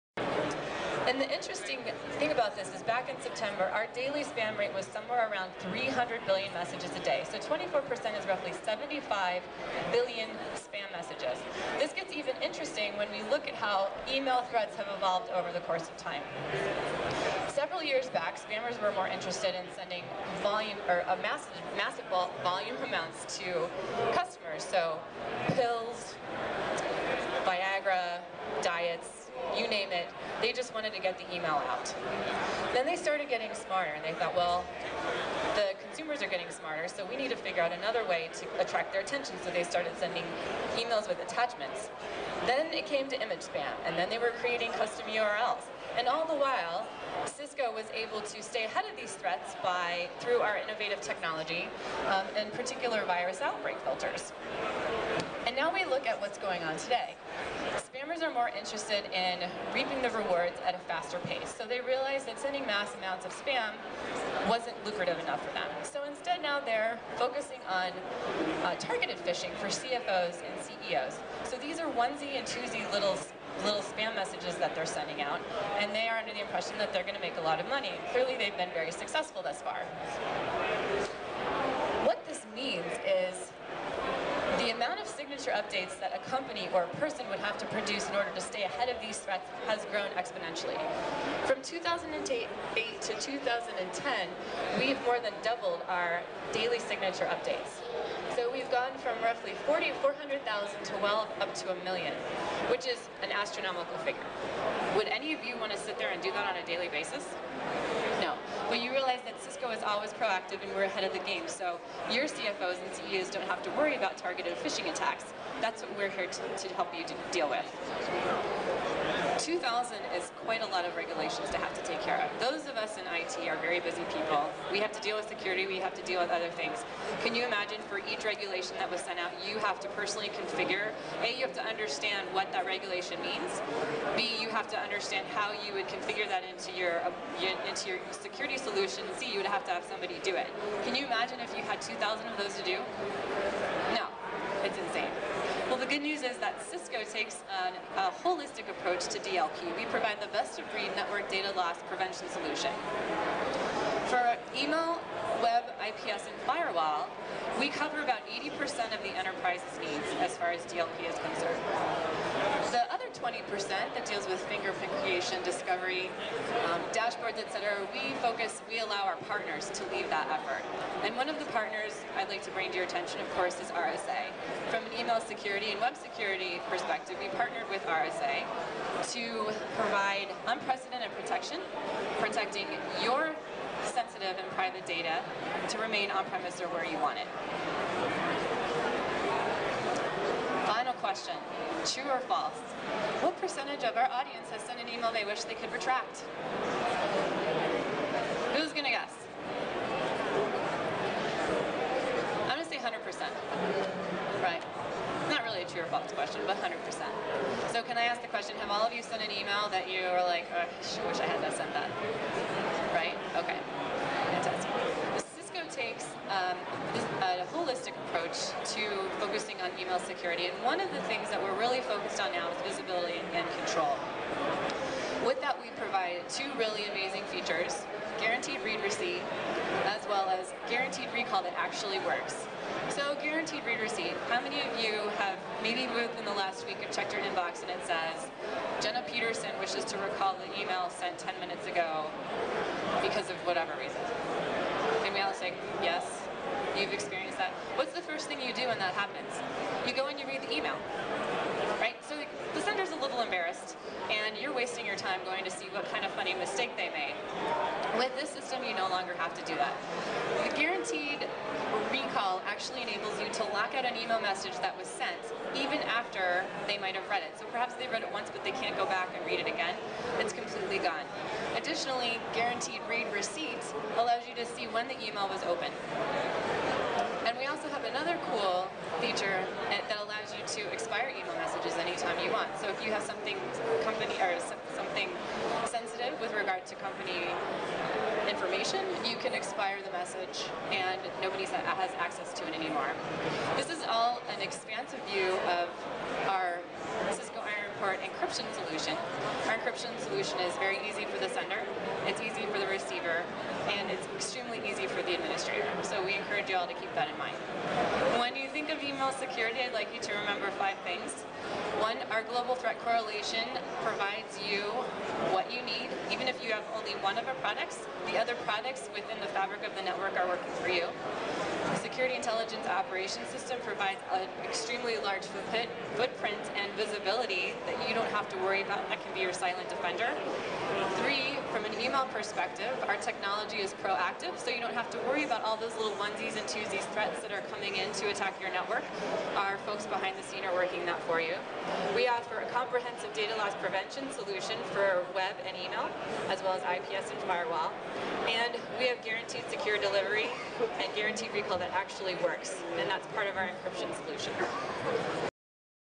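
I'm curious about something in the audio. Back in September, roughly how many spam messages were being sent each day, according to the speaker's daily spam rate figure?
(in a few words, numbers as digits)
300 billion.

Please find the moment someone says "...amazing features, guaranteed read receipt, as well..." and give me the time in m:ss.
3:46.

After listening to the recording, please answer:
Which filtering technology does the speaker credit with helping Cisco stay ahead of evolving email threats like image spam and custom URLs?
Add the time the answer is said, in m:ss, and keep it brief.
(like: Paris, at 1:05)
virus outbreak filters, at 0:53.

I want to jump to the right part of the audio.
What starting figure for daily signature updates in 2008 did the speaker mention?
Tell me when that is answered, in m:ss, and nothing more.
1:40.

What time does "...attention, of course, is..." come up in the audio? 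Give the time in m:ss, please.
2:52.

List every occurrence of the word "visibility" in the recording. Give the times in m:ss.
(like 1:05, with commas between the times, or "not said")
3:42, 5:26.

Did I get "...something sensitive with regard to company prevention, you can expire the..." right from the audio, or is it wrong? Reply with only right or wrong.
wrong.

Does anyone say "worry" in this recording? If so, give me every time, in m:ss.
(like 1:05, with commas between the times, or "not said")
1:53, 5:28, 5:35.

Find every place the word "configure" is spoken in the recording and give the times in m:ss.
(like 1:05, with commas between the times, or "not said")
2:10, 2:15.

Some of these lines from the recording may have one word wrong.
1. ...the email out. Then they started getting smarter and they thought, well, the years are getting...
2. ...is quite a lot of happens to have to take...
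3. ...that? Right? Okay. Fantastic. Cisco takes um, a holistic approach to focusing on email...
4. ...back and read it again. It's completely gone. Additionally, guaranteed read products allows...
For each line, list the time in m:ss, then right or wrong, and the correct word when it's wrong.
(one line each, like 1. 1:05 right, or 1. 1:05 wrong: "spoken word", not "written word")
1. 0:31 wrong: "consumers", not "years"
2. 2:00 wrong: "regulations", not "happens"
3. 3:31 right
4. 4:28 wrong: "receipts", not "products".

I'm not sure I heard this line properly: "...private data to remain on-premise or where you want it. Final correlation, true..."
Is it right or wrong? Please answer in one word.
wrong.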